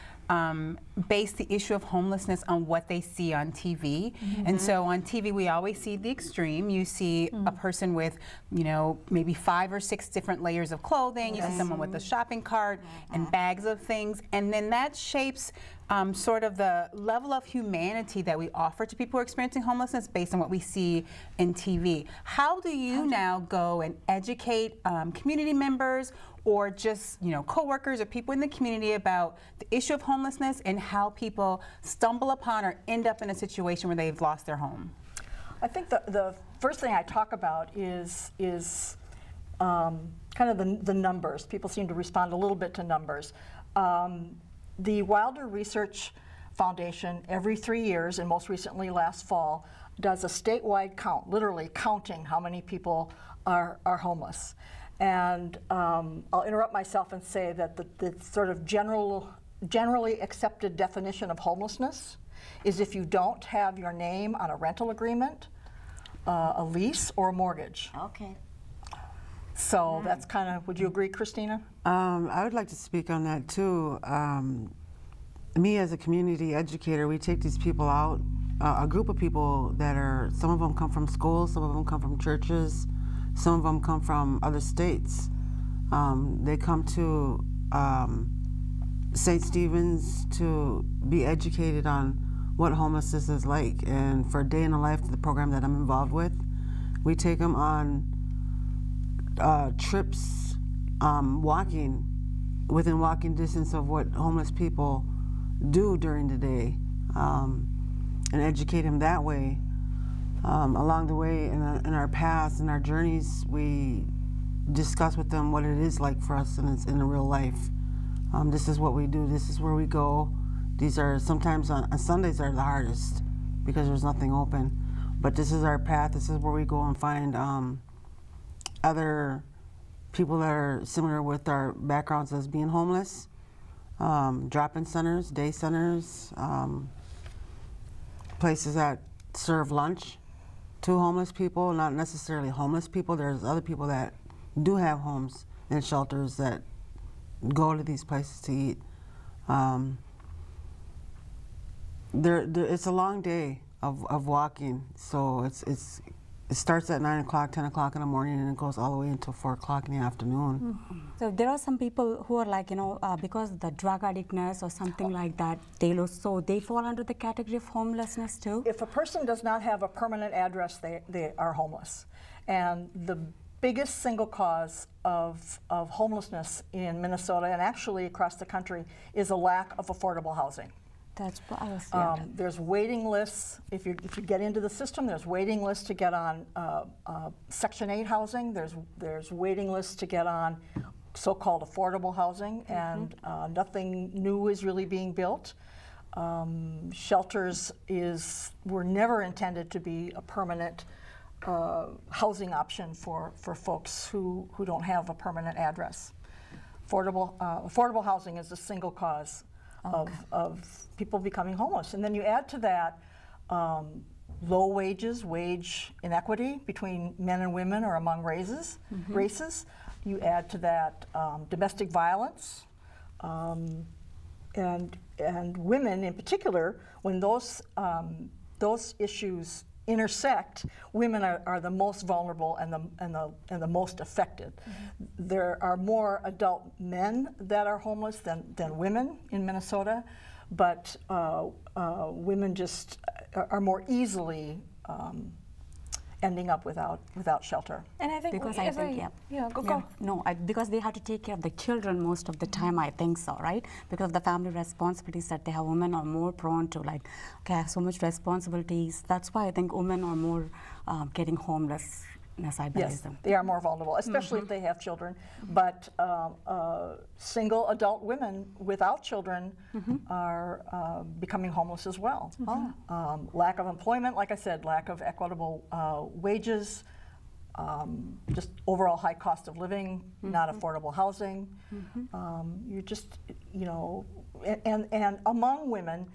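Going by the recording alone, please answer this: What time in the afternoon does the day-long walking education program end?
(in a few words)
4 o'clock.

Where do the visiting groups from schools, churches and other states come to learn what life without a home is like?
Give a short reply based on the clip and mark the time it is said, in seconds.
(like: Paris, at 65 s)
St. Stephen's, at 89 s.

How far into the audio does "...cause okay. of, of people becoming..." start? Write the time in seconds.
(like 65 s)
208 s.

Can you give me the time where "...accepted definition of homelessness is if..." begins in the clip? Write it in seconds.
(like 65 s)
60 s.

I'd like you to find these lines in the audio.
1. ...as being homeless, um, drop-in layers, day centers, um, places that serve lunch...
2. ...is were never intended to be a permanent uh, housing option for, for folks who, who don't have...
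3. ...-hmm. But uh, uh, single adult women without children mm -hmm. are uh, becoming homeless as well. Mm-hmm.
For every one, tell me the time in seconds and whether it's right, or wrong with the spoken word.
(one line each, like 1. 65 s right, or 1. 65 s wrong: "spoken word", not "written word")
1. 132 s wrong: "centers", not "layers"
2. 197 s right
3. 265 s right.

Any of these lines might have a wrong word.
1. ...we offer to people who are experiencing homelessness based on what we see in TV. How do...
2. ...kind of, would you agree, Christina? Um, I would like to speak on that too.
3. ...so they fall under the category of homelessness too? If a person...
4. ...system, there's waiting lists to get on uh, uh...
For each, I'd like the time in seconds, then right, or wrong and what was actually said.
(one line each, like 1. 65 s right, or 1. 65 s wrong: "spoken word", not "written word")
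1. 18 s right
2. 70 s right
3. 166 s right
4. 184 s right.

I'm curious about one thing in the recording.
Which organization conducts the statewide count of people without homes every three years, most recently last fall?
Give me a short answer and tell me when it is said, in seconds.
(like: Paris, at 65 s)
Wilder Research Foundation, at 45 s.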